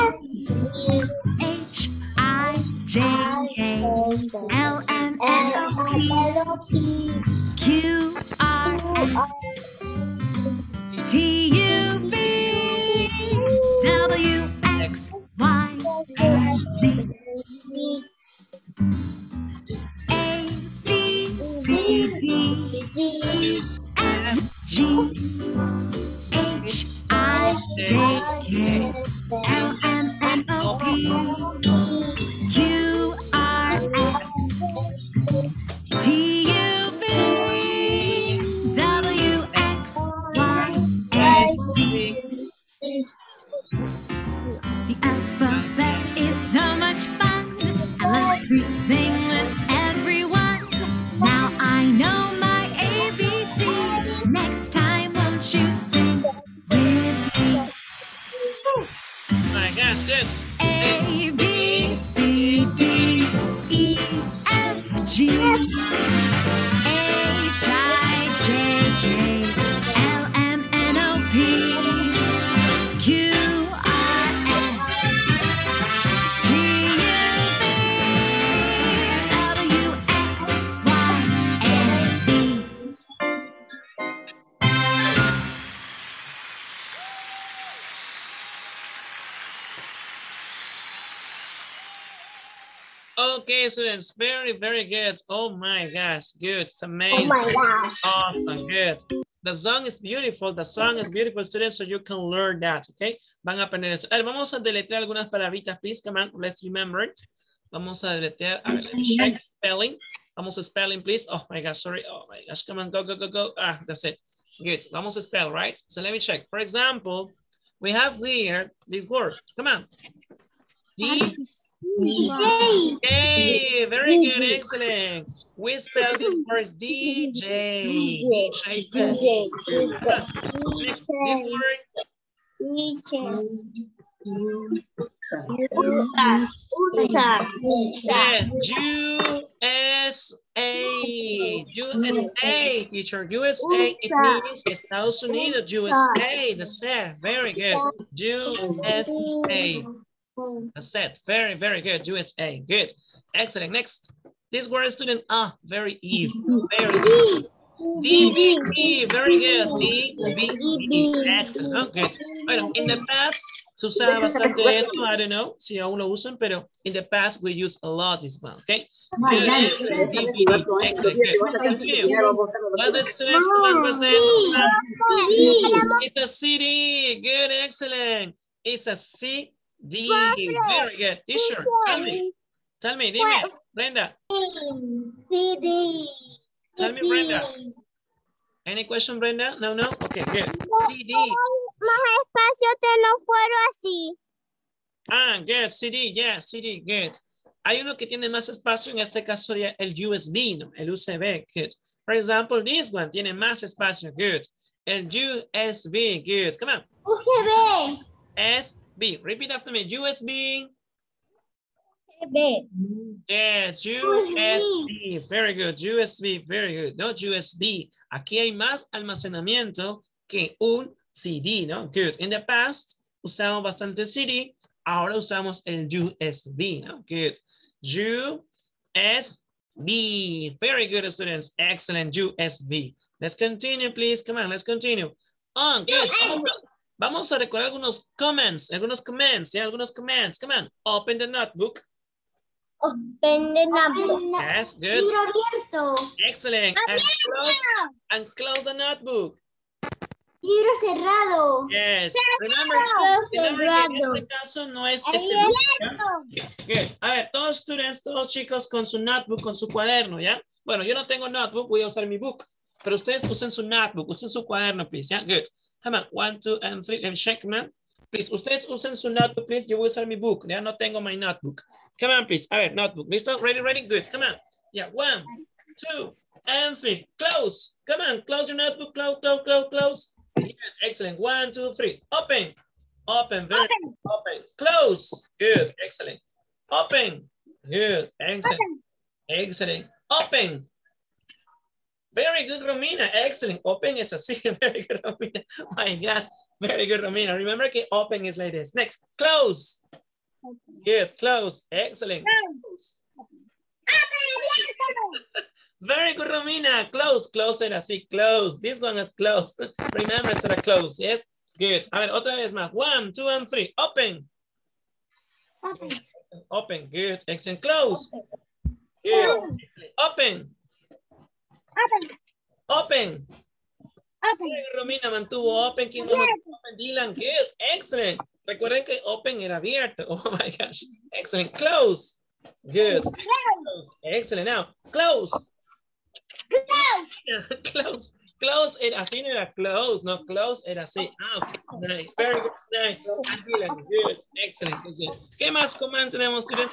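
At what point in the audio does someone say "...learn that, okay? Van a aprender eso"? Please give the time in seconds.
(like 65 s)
102 s.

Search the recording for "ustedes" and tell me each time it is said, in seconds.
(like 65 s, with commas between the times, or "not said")
262 s, 268 s.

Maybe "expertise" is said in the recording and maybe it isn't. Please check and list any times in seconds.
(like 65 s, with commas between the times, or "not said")
not said.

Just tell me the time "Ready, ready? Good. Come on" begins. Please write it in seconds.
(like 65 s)
273 s.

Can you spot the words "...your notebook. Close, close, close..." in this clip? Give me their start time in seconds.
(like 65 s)
278 s.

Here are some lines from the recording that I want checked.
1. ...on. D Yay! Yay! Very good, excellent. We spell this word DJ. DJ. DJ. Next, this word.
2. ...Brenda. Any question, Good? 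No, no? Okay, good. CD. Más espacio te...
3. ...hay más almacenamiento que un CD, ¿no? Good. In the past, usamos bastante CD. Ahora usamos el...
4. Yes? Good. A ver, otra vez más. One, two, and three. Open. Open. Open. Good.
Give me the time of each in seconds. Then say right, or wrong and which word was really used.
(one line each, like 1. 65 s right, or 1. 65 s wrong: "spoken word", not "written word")
1. 119 s right
2. 187 s wrong: "Brenda", not "Good"
3. 218 s right
4. 311 s right.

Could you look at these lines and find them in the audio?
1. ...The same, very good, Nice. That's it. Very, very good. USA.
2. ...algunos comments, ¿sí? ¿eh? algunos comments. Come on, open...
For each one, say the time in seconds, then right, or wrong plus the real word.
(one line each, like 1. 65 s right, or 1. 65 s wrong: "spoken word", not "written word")
1. 146 s wrong: "USA", not "Nice"
2. 238 s right.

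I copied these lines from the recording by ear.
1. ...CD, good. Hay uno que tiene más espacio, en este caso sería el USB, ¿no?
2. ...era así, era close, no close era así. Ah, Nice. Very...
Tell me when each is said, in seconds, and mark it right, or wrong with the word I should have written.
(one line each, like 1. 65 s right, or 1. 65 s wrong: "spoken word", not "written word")
1. 196 s right
2. 338 s right.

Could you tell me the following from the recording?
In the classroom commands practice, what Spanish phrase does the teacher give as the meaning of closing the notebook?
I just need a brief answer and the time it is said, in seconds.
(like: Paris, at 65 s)
Libro cerrado, at 250 s.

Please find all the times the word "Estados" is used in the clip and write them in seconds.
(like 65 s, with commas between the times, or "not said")
144 s.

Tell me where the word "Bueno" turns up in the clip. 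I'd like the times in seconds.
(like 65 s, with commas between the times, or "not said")
162 s, 260 s.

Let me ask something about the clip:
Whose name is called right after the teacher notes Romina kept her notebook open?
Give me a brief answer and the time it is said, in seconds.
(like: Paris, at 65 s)
Dylan, at 326 s.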